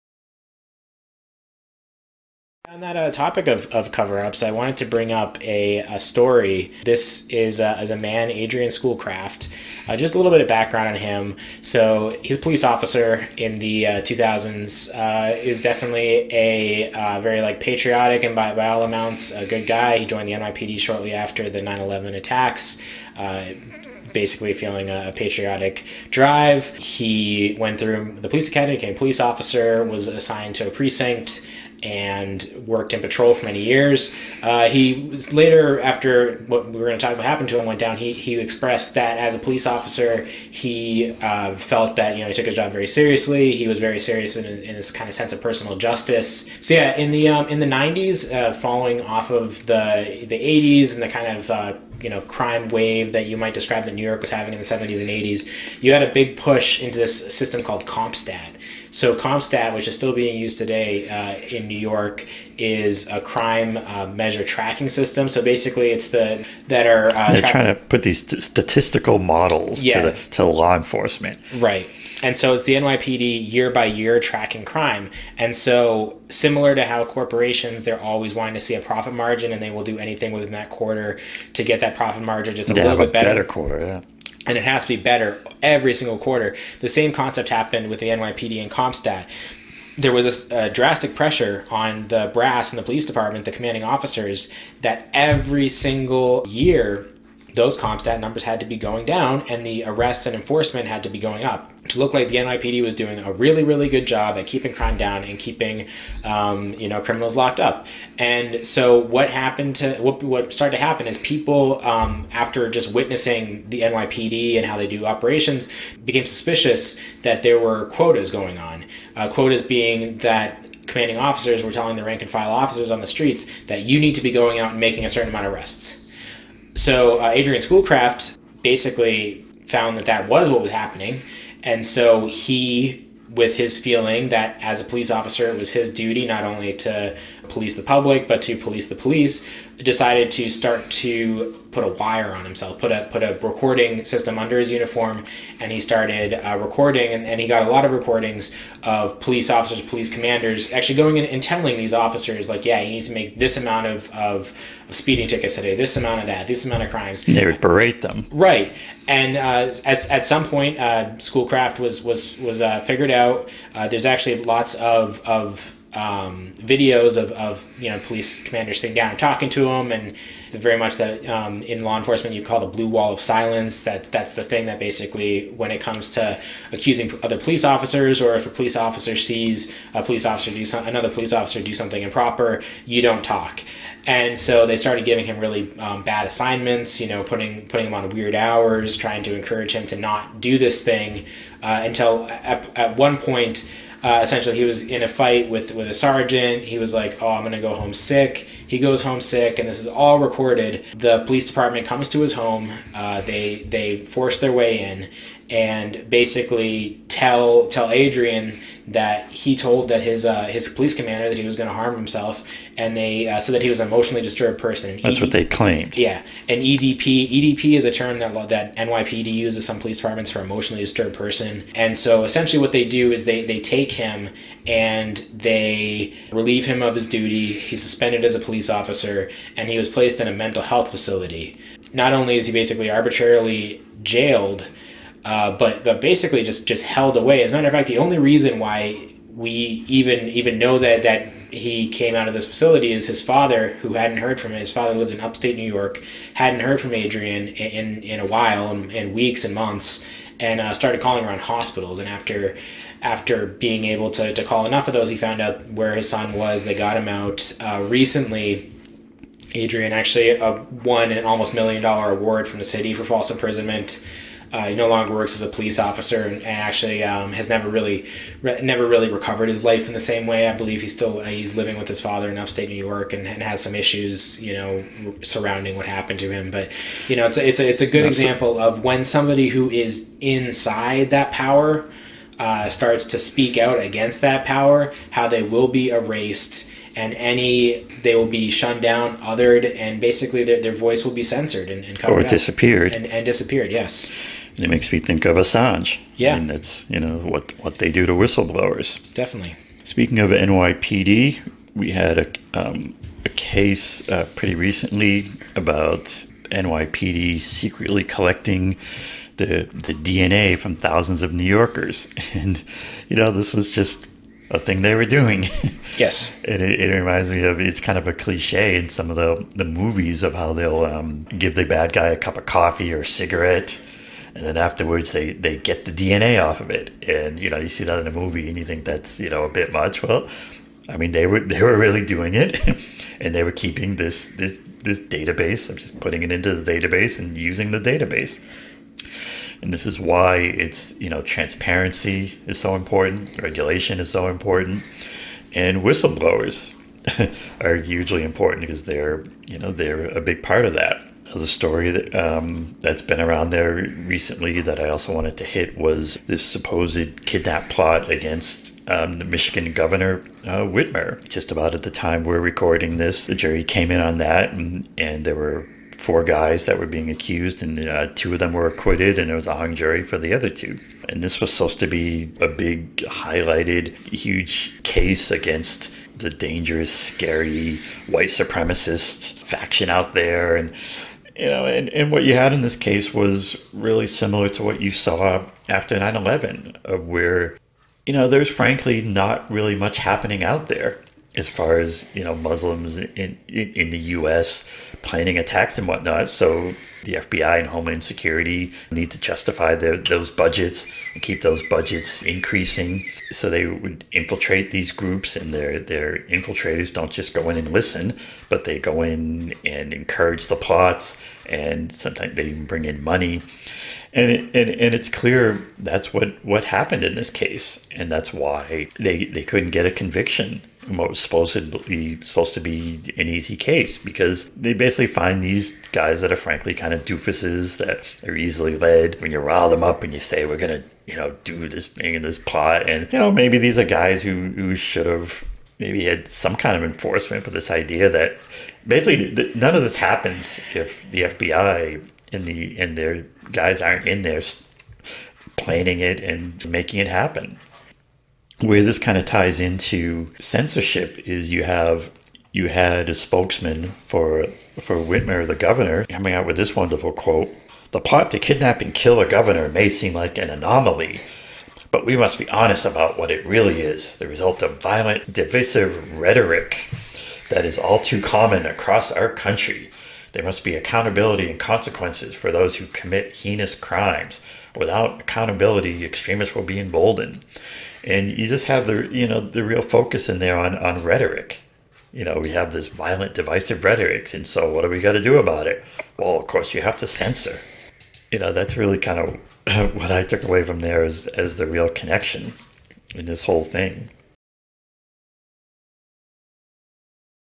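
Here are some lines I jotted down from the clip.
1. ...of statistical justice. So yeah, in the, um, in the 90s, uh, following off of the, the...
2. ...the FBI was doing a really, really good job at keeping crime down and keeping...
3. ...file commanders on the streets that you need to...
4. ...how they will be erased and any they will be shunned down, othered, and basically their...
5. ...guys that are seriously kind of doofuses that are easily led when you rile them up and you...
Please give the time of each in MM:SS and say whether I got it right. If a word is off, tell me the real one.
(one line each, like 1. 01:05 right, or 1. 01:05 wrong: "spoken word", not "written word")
1. 00:45 wrong: "personal", not "statistical"
2. 01:42 wrong: "NYPD", not "FBI"
3. 02:02 wrong: "officers", not "commanders"
4. 04:45 right
5. 07:05 wrong: "frankly", not "seriously".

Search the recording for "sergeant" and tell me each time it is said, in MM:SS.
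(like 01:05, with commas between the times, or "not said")
03:15.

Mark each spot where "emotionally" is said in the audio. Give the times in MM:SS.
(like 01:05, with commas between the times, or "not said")
03:33, 03:40.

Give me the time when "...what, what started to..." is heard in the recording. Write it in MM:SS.
01:49.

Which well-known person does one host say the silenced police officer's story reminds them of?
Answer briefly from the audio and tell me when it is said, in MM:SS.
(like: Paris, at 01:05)
Assange, at 04:55.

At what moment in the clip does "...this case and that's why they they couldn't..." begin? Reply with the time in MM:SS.
06:57.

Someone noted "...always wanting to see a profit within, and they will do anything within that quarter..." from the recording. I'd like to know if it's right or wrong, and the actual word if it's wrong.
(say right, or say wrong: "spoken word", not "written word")
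wrong: "margin", not "within".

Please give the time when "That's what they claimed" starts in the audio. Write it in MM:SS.
03:35.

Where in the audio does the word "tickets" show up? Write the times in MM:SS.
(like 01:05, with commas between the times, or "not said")
02:35.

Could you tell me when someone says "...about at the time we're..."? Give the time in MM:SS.
06:01.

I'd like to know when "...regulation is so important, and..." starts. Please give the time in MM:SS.
05:43.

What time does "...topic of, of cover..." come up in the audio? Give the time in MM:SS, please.
00:03.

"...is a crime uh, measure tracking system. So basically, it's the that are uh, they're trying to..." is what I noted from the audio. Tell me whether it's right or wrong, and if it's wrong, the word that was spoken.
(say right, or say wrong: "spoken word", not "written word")
right.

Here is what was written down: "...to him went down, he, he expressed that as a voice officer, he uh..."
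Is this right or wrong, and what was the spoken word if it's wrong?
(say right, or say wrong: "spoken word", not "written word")
wrong: "police", not "voice".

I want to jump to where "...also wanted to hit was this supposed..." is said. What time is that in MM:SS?
05:54.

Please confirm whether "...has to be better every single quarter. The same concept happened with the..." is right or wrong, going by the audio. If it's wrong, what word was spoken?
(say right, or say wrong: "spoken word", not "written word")
right.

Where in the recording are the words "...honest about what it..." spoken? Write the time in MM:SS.
07:42.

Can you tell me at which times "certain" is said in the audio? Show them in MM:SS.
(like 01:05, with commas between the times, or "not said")
02:05.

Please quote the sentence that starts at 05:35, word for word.
I'm just putting it into the database and using the database.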